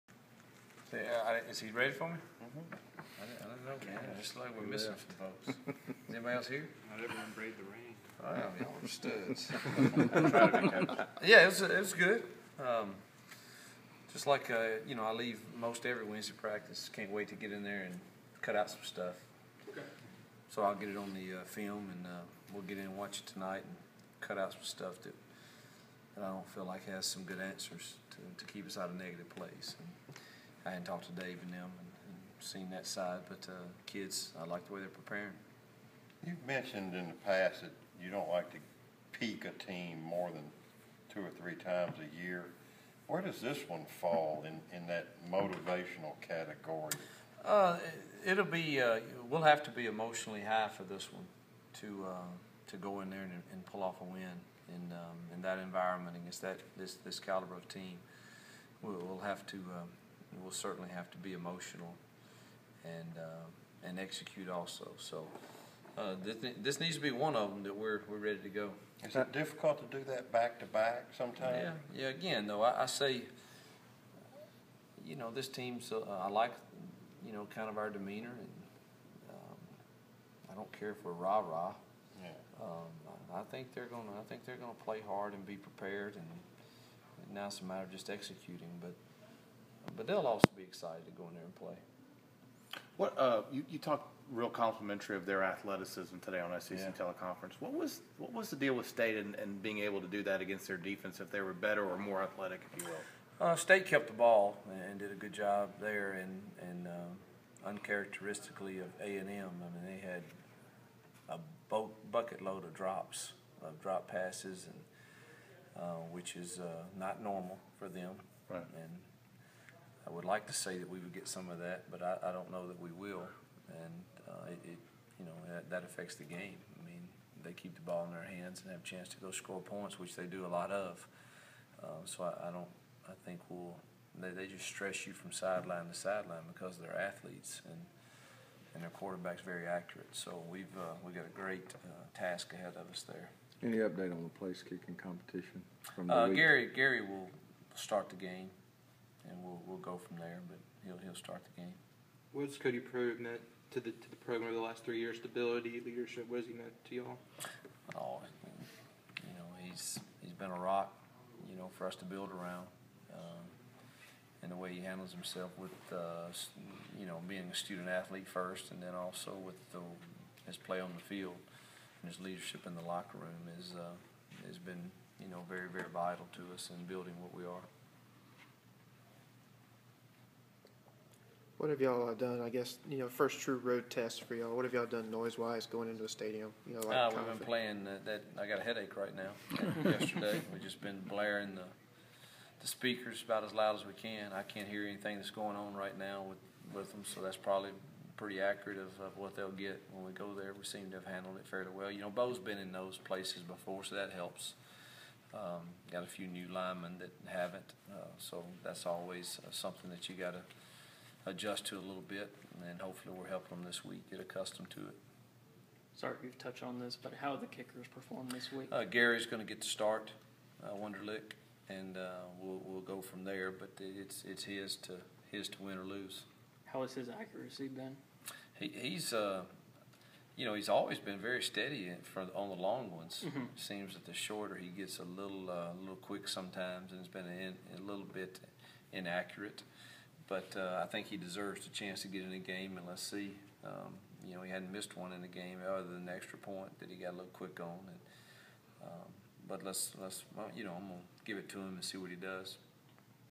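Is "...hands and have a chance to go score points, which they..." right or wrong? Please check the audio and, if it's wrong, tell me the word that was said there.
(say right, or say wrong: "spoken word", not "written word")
right.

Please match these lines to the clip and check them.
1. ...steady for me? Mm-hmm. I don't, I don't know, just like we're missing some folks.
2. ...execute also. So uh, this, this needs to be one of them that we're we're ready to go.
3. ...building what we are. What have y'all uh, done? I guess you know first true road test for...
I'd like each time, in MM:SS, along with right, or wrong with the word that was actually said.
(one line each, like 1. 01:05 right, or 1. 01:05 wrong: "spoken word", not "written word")
1. 00:01 wrong: "ready", not "steady"
2. 01:03 right
3. 02:56 right.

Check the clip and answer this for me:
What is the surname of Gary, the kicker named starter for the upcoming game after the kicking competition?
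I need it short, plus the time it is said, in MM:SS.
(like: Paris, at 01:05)
Wunderlich, at 03:40.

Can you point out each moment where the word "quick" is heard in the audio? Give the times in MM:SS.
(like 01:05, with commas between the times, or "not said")
03:55, 04:07.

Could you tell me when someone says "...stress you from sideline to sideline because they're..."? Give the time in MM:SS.
02:14.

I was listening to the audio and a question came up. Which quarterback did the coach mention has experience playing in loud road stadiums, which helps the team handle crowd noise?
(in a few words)
Bo.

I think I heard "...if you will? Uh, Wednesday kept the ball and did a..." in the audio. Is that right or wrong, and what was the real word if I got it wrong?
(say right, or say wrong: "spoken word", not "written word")
wrong: "State", not "Wednesday".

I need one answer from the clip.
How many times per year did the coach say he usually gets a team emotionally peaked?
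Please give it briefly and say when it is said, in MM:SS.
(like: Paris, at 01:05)
2 or 3, at 00:41.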